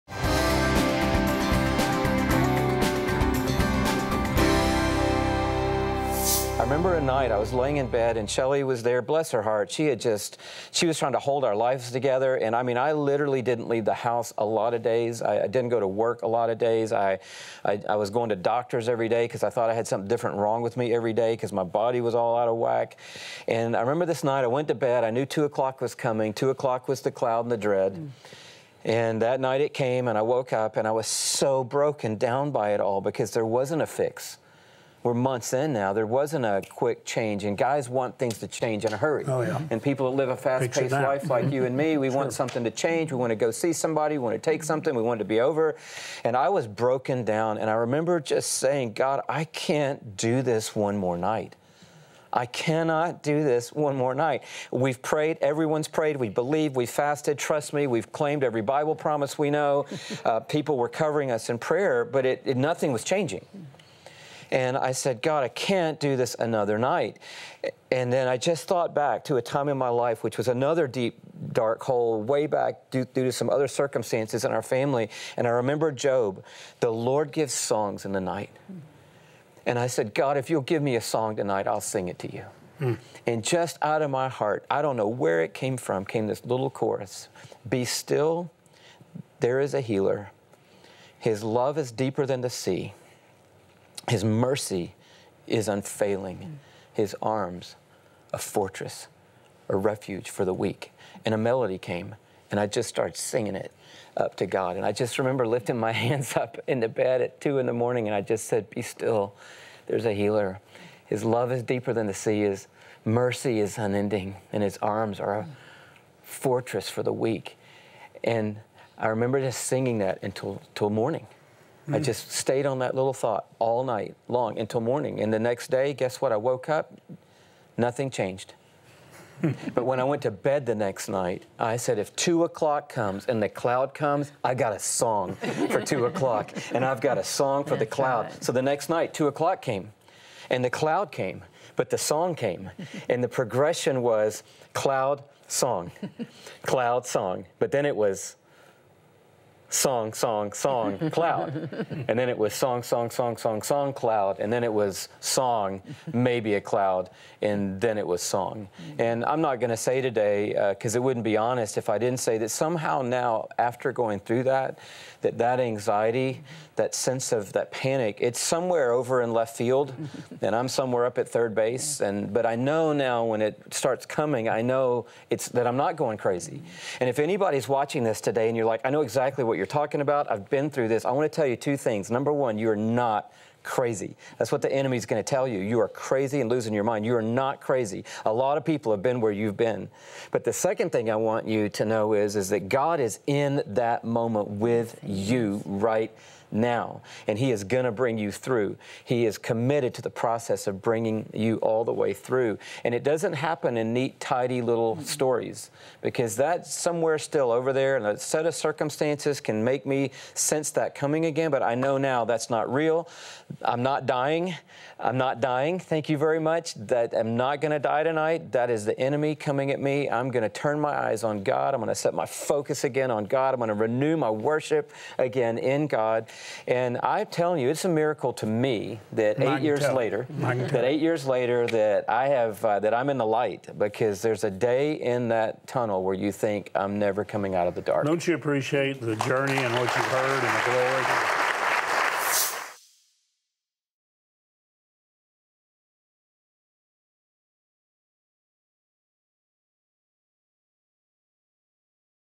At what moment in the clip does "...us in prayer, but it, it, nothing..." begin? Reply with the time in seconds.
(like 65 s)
61 s.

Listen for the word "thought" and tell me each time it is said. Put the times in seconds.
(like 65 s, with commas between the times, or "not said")
19 s, 68 s, 123 s.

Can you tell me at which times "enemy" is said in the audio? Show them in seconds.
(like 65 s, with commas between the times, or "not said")
184 s, 218 s.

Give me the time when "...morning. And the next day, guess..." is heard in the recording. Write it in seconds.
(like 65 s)
124 s.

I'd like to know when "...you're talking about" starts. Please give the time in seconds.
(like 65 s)
179 s.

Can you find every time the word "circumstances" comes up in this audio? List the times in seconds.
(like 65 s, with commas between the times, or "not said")
73 s, 208 s.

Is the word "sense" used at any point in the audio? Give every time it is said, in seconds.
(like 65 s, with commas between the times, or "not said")
166 s, 210 s.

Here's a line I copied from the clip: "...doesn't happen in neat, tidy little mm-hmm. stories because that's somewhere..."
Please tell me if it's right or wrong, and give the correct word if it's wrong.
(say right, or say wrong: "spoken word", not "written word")
right.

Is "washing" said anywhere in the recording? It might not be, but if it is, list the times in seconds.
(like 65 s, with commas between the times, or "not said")
not said.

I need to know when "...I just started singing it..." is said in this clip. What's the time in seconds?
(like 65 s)
102 s.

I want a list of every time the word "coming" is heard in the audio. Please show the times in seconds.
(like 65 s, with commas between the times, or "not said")
25 s, 174 s, 210 s, 219 s, 237 s.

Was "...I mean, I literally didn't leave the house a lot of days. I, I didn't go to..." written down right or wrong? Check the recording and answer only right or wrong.
right.